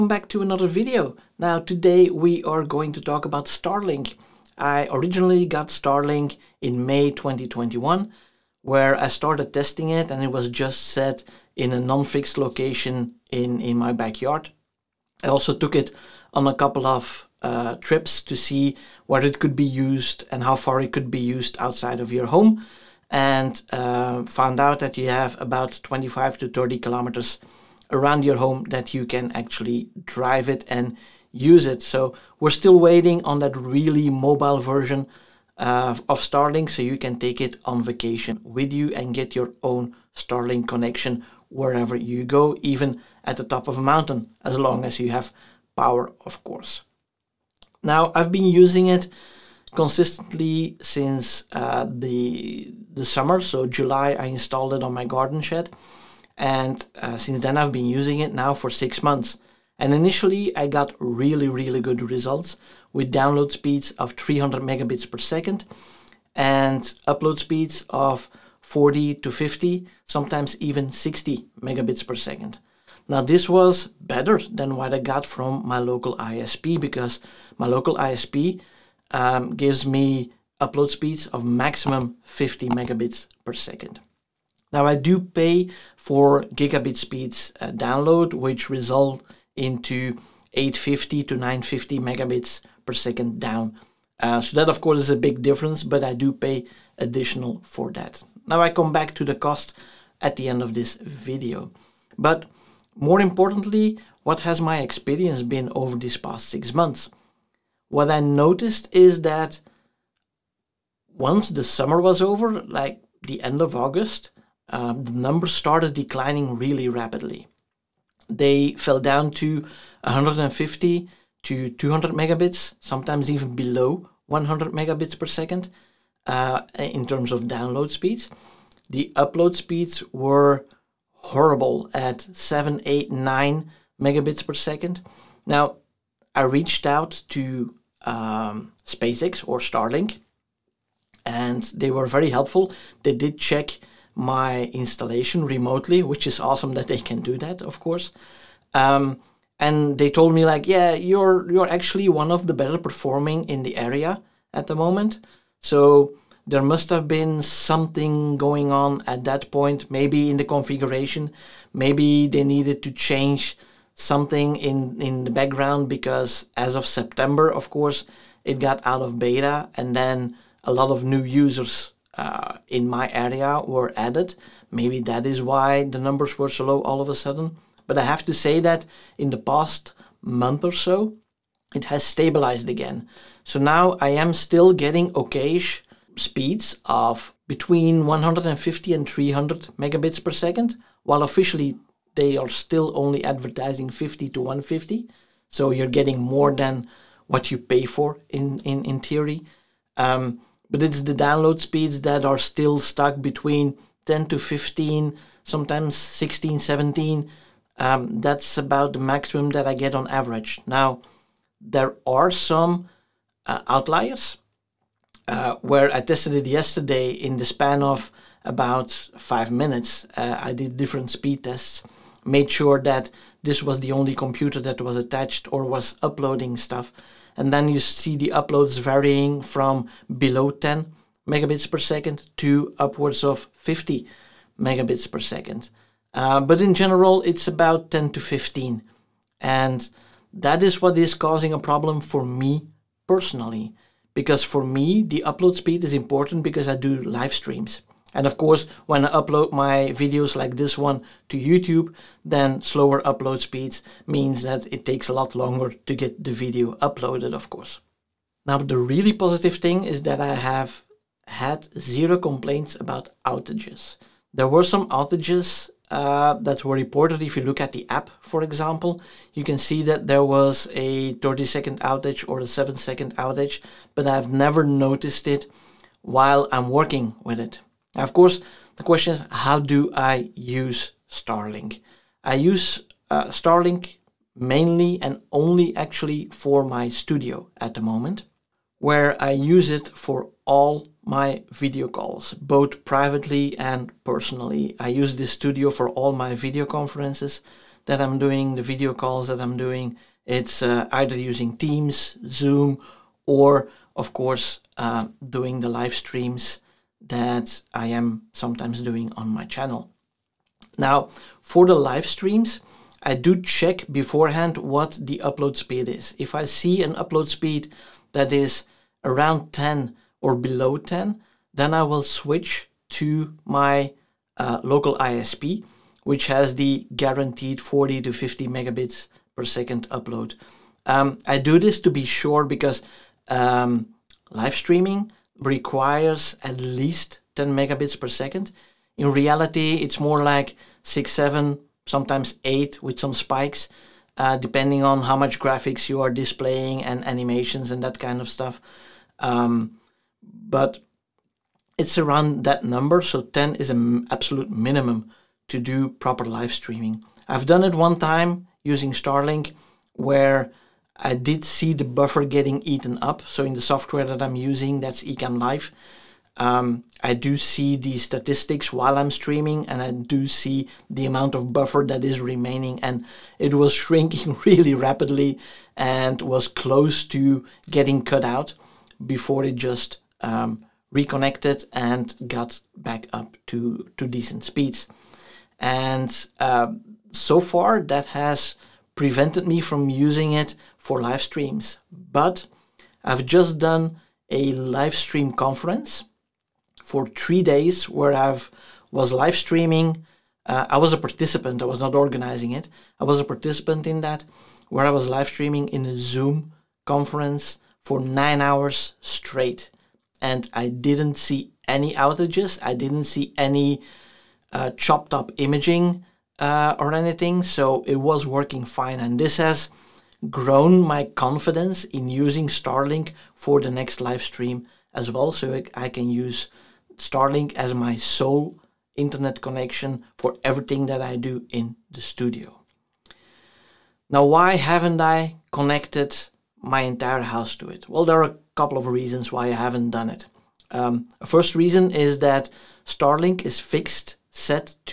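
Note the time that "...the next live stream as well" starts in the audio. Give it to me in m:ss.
7:03.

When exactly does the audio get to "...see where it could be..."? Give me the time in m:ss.
0:18.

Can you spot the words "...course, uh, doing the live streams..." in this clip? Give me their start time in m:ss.
5:04.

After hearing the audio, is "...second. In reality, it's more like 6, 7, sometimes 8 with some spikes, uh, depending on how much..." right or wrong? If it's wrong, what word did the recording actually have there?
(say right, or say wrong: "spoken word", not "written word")
right.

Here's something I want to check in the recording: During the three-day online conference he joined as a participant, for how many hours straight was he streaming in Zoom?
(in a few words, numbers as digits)
9 hours.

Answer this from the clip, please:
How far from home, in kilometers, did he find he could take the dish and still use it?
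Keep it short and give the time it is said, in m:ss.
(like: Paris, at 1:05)
25 to 30 kilometers, at 0:25.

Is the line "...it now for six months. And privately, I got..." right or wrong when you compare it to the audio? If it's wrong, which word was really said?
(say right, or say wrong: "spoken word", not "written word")
wrong: "initially", not "privately".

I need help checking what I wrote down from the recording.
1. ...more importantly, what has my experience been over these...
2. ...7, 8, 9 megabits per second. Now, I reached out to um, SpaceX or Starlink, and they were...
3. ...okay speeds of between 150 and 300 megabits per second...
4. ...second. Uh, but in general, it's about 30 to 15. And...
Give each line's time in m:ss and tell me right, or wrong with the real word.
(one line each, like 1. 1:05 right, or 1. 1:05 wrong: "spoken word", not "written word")
1. 1:42 right
2. 2:12 right
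3. 3:05 right
4. 3:55 wrong: "10", not "30".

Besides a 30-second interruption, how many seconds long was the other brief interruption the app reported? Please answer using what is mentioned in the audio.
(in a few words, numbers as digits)
7 seconds.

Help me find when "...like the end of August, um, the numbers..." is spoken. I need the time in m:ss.
1:52.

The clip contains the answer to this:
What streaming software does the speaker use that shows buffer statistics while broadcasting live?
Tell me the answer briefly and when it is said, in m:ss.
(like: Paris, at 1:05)
Ecamm Live, at 6:05.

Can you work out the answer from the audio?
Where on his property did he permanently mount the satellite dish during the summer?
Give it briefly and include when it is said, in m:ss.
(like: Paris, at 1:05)
garden shed, at 0:55.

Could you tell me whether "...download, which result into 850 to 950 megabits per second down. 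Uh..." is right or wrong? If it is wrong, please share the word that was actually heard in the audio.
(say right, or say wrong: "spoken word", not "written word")
right.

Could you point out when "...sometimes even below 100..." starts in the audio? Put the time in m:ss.
2:02.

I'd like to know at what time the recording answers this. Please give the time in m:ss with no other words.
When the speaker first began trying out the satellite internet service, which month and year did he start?
0:06.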